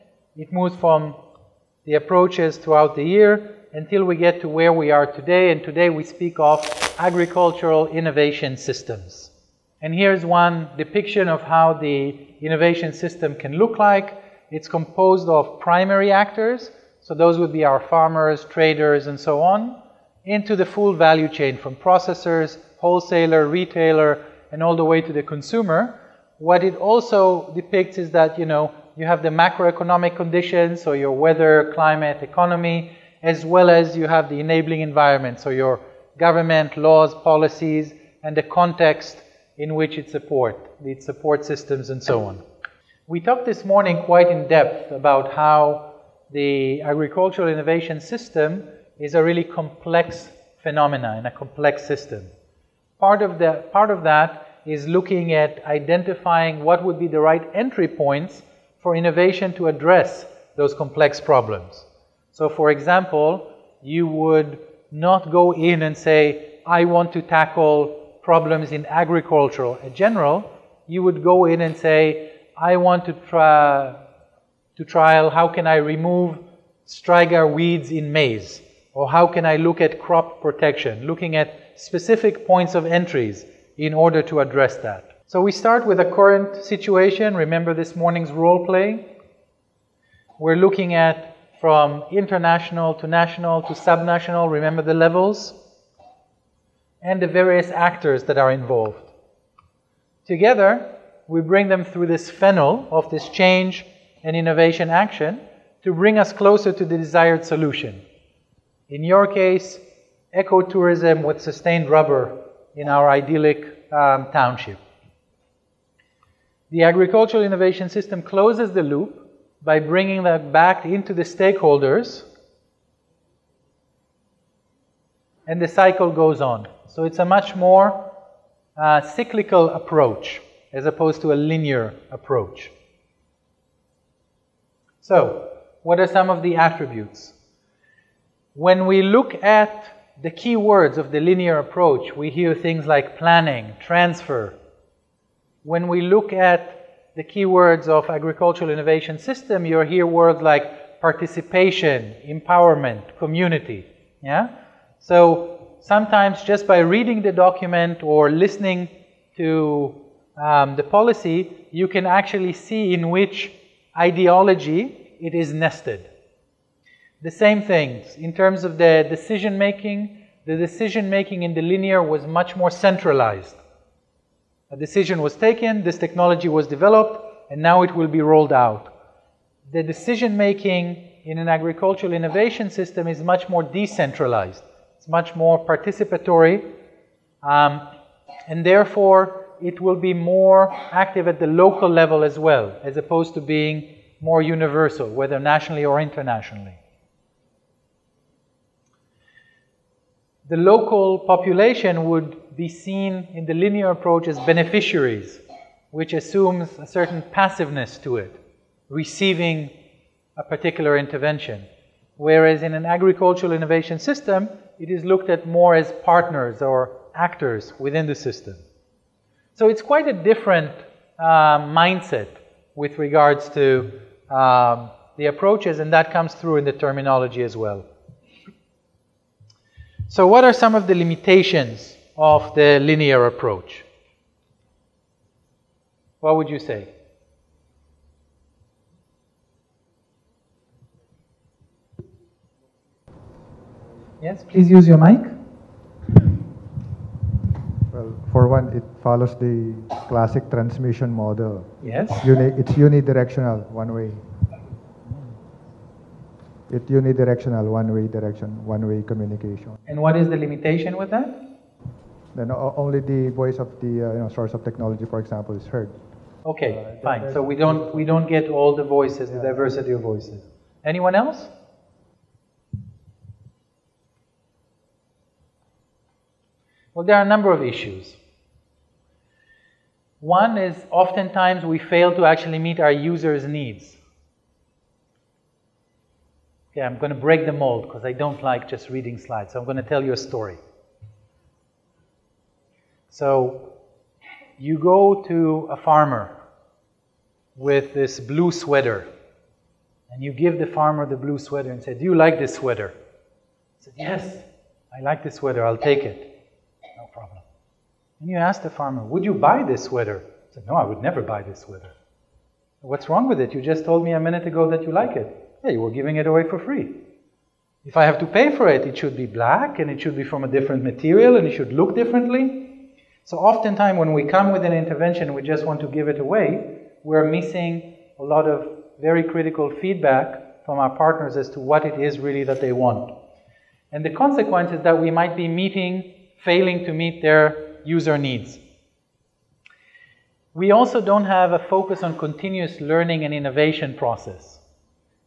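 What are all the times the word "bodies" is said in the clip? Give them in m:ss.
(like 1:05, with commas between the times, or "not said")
not said.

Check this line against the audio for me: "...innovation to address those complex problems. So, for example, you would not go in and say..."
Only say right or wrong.
right.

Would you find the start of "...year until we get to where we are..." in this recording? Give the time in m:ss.
0:03.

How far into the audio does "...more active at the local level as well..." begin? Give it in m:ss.
3:10.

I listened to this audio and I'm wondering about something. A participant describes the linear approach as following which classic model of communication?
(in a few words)
Transmission model.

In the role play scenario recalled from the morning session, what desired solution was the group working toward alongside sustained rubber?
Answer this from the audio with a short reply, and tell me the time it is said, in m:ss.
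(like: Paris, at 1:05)
Ecotourism, at 1:50.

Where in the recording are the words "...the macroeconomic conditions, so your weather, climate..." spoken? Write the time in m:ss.
0:29.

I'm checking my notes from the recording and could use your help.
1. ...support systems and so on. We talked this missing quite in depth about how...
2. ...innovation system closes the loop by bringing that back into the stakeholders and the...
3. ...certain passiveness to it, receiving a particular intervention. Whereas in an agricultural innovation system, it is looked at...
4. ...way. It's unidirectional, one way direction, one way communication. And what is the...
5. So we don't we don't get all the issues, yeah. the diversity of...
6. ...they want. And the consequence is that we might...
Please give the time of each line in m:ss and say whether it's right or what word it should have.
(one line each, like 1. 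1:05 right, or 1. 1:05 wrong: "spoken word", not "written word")
1. 0:41 wrong: "morning", not "missing"
2. 1:57 right
3. 3:26 right
4. 4:13 right
5. 4:27 wrong: "voices", not "issues"
6. 5:32 right.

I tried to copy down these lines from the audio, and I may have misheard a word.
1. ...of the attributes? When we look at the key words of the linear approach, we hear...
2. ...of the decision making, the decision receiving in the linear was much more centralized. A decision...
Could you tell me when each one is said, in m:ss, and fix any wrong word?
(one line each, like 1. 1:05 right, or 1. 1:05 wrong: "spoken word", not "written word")
1. 2:16 right
2. 2:48 wrong: "making", not "receiving".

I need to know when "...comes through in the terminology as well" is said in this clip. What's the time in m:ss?
3:46.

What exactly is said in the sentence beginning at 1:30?
We're looking at from international to national to subnational, remember the levels?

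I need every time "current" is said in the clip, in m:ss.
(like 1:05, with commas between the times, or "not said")
1:26.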